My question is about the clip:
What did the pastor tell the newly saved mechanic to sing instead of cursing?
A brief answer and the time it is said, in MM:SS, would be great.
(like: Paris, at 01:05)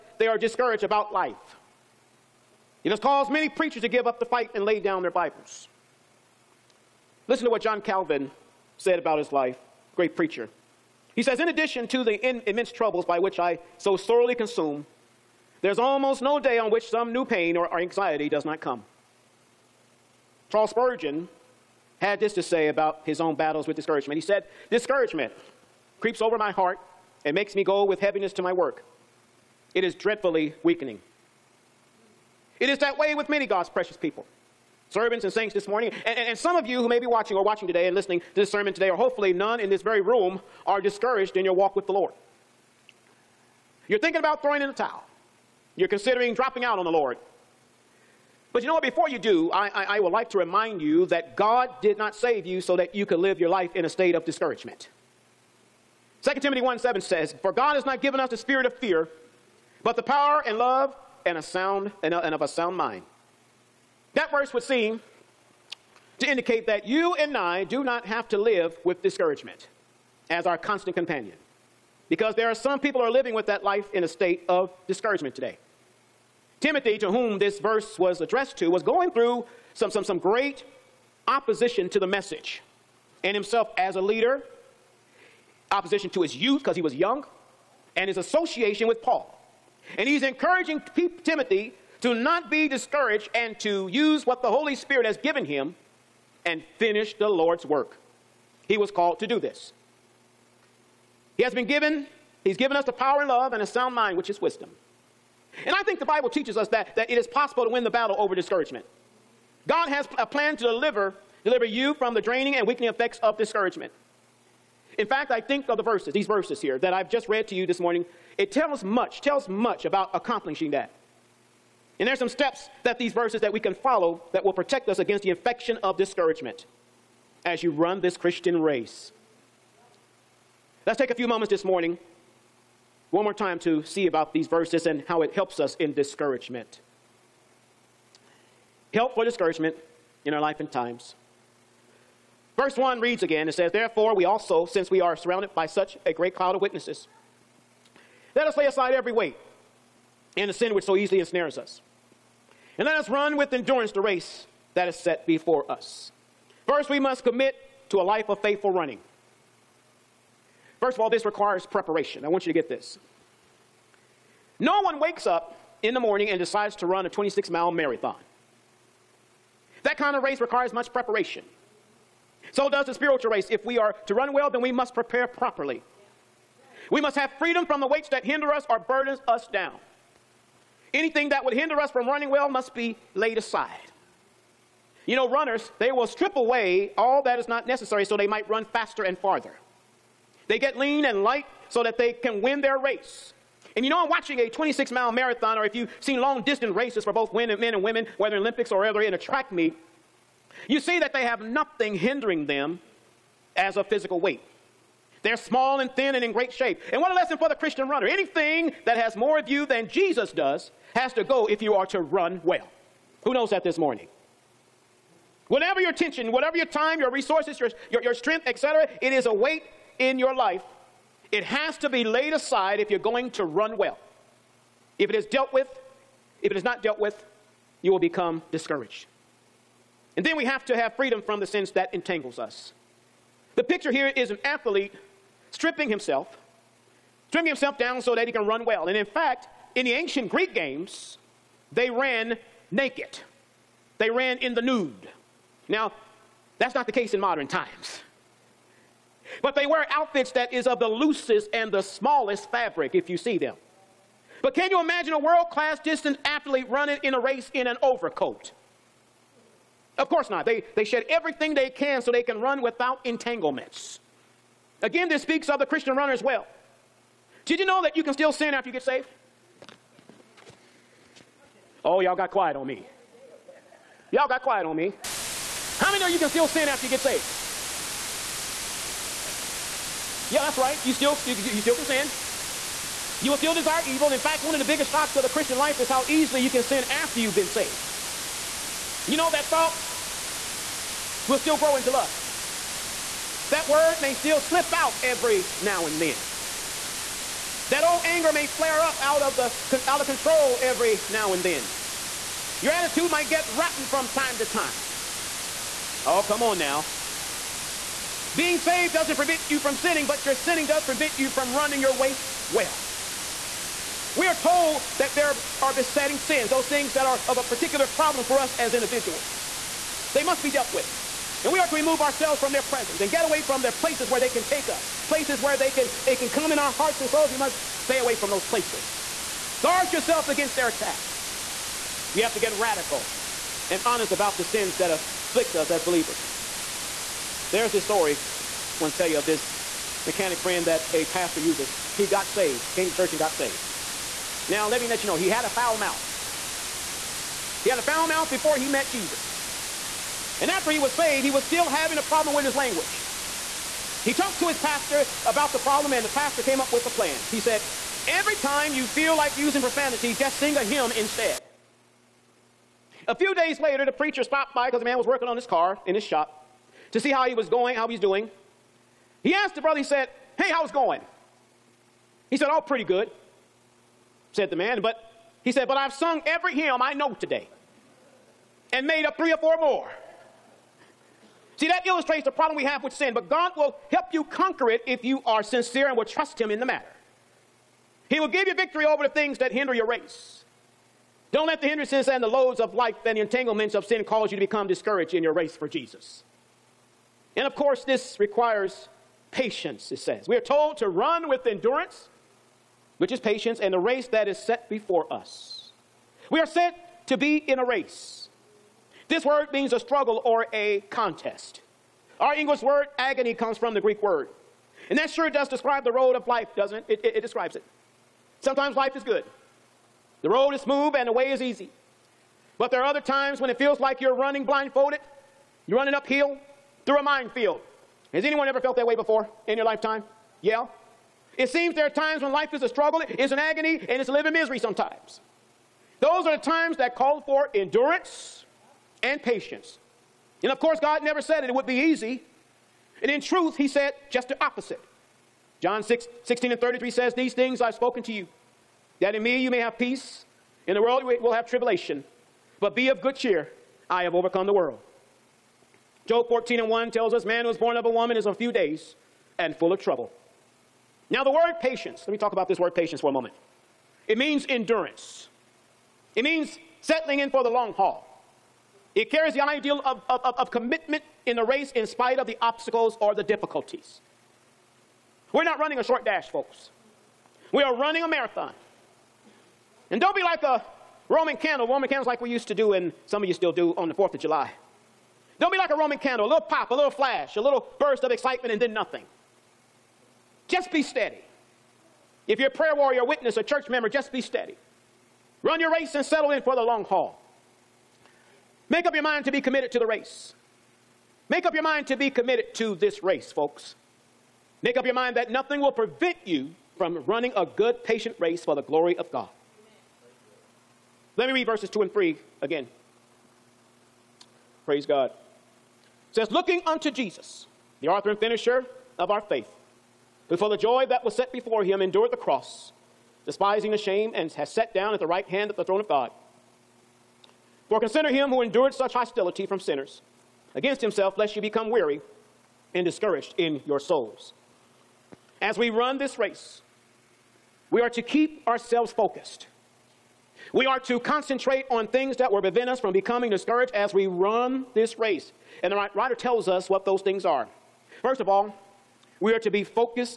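a hymn, at 06:00.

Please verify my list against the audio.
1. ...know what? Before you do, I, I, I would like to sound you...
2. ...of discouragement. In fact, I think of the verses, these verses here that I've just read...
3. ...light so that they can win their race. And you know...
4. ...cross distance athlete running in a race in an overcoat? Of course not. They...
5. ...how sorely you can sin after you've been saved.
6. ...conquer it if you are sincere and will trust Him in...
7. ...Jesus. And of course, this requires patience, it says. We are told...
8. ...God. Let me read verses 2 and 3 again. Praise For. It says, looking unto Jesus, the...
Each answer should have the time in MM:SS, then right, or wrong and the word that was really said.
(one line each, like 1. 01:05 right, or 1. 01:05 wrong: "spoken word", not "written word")
1. 00:48 wrong: "remind", not "sound"
2. 01:53 right
3. 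03:11 right
4. 04:15 wrong: "class", not "cross"
5. 04:45 wrong: "easily", not "sorely"
6. 06:24 right
7. 06:35 right
8. 08:29 wrong: "God", not "For".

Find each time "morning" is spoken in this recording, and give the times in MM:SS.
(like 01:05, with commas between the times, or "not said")
00:35, 01:57, 02:11, 02:45, 03:33.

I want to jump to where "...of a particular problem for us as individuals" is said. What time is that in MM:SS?
05:17.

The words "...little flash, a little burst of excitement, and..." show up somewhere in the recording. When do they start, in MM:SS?
08:06.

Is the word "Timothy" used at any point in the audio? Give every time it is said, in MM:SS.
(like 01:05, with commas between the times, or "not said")
00:56, 01:16, 01:31.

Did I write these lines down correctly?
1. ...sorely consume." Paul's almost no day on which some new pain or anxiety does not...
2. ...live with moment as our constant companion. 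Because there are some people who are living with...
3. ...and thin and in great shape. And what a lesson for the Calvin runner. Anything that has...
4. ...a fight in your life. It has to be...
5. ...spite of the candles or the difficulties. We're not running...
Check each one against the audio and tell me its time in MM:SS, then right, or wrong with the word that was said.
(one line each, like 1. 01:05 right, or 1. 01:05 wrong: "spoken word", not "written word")
1. 00:13 wrong: "There", not "Paul"
2. 01:08 wrong: "discouragement", not "moment"
3. 03:25 wrong: "Christian", not "Calvin"
4. 03:39 wrong: "weight", not "fight"
5. 07:51 wrong: "obstacles", not "candles".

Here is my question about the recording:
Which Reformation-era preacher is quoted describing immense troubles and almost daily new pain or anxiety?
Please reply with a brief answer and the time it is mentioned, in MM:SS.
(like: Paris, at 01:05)
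John Calvin, at 00:07.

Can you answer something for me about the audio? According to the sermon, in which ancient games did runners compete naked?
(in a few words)
Greek games.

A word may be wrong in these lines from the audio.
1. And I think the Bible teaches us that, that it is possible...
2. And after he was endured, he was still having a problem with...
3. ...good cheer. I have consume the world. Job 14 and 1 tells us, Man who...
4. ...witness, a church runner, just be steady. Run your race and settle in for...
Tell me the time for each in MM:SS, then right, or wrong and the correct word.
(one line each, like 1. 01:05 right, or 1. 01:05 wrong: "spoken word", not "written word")
1. 01:45 right
2. 05:50 wrong: "saved", not "endured"
3. 07:33 wrong: "overcome", not "consume"
4. 08:13 wrong: "member", not "runner".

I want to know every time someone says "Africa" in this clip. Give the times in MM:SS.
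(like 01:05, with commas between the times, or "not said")
not said.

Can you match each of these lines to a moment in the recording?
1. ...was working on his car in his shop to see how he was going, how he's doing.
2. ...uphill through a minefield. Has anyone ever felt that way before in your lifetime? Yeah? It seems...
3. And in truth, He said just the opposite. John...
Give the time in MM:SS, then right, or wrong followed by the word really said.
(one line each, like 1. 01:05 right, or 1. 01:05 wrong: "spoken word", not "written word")
1. 06:04 right
2. 07:05 right
3. 07:23 right.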